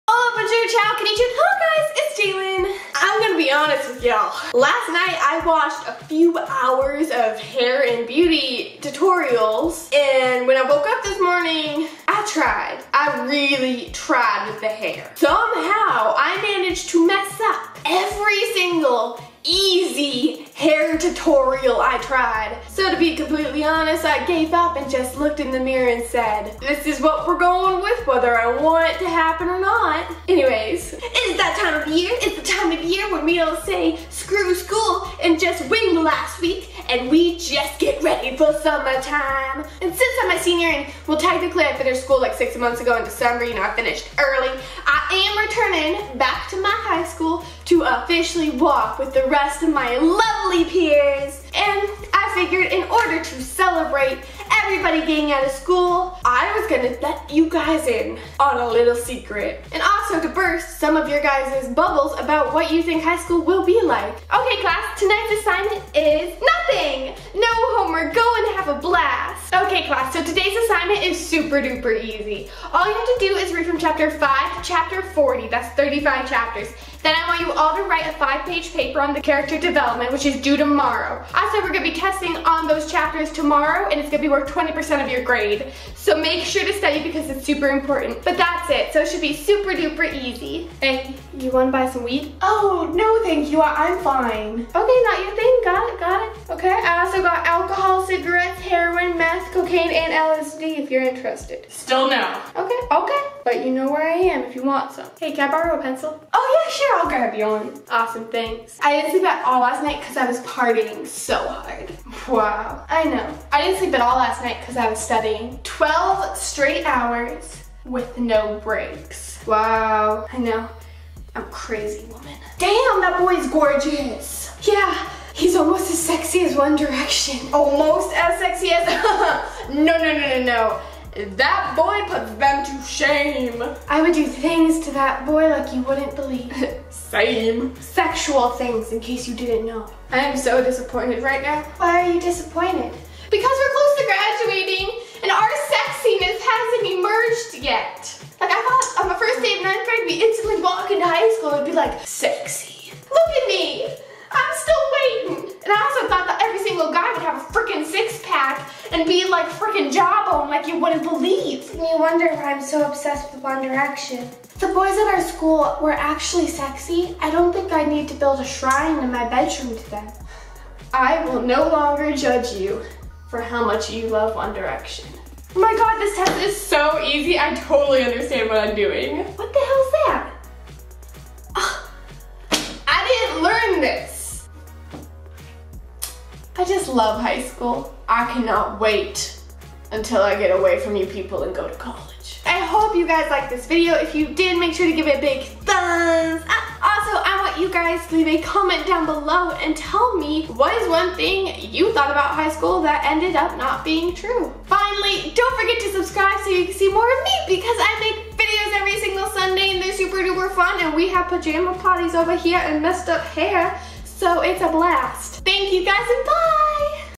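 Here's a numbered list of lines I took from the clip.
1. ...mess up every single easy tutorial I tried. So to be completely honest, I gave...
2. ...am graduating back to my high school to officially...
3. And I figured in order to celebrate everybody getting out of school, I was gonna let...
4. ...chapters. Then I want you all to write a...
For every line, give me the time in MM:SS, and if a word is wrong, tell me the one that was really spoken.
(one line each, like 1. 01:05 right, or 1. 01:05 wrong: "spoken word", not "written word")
1. 00:17 right
2. 00:45 wrong: "returning", not "graduating"
3. 00:51 right
4. 01:16 right.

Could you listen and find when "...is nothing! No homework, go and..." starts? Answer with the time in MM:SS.
01:05.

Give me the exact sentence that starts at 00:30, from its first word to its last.
Anyways, it's that time of year.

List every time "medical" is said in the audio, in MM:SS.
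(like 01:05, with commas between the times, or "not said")
not said.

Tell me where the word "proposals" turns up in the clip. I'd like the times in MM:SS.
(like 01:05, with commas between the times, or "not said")
not said.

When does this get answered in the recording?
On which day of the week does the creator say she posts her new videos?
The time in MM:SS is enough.
03:29.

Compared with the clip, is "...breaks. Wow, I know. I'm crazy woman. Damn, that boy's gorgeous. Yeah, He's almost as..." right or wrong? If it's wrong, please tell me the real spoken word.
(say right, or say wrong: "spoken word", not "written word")
right.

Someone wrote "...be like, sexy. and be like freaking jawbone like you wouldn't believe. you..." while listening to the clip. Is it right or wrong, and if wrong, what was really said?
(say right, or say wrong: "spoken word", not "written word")
right.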